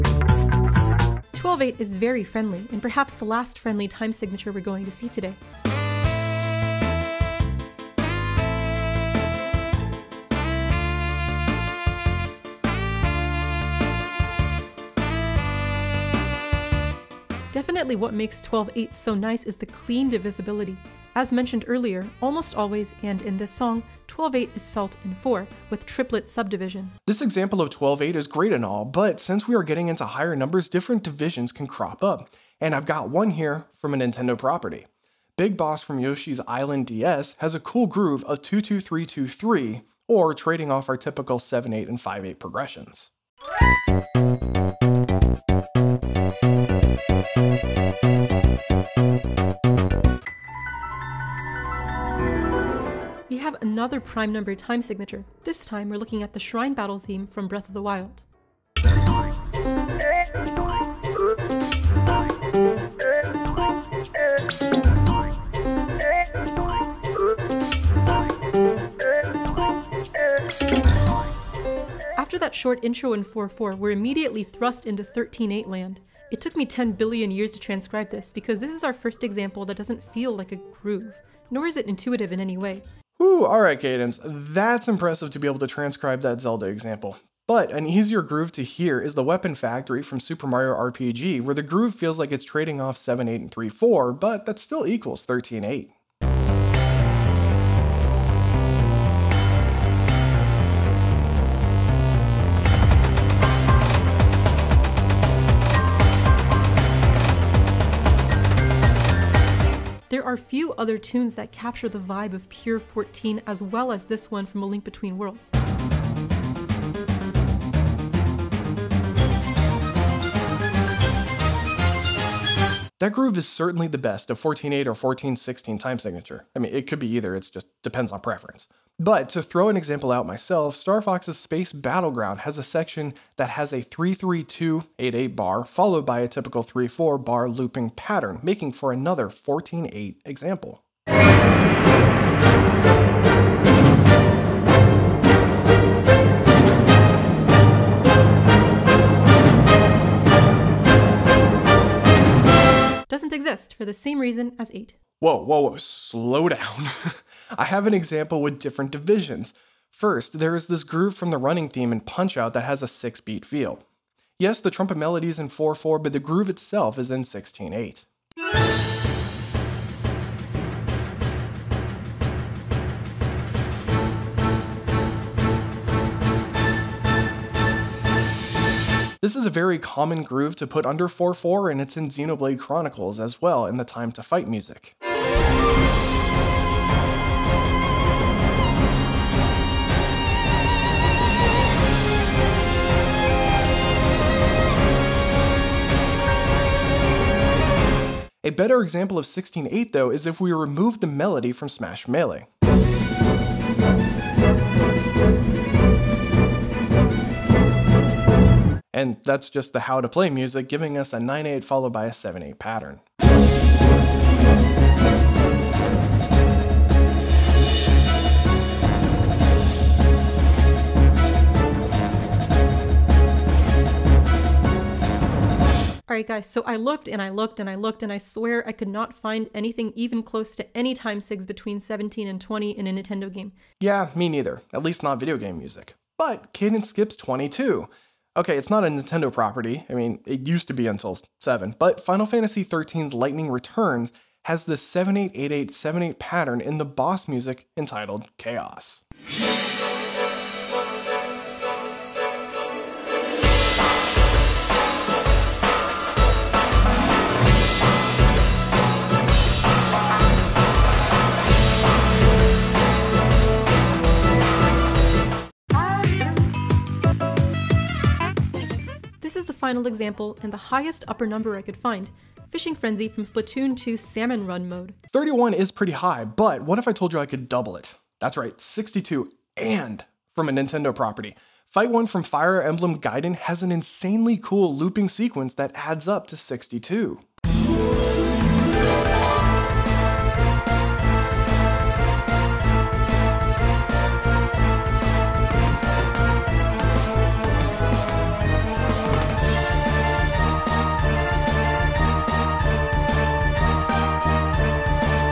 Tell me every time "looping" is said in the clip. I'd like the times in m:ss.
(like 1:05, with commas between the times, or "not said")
2:17, 4:44.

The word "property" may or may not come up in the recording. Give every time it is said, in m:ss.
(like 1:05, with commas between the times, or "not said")
0:34, 3:59, 4:40.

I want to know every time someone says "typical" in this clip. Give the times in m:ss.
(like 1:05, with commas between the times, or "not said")
0:40, 2:16.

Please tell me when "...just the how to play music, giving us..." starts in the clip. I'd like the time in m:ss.
3:29.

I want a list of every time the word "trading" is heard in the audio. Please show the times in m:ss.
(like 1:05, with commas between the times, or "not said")
0:40, 1:32.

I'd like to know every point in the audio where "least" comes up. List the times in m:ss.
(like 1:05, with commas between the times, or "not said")
3:54.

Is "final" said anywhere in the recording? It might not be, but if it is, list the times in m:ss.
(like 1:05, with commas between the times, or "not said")
4:02, 4:29.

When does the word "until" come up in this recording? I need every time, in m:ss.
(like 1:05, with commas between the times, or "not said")
4:00.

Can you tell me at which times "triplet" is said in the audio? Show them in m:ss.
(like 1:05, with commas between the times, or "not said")
0:25.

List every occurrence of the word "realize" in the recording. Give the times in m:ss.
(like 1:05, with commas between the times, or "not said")
not said.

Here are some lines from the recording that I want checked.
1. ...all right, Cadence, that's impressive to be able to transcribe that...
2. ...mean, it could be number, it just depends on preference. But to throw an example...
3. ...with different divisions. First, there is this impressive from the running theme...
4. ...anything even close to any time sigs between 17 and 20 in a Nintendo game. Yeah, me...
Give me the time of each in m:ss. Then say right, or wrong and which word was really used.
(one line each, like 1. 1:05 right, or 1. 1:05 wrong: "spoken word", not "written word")
1. 1:23 right
2. 2:06 wrong: "either", not "number"
3. 2:38 wrong: "groove", not "impressive"
4. 3:49 right.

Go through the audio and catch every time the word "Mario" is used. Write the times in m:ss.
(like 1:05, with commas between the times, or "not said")
1:30.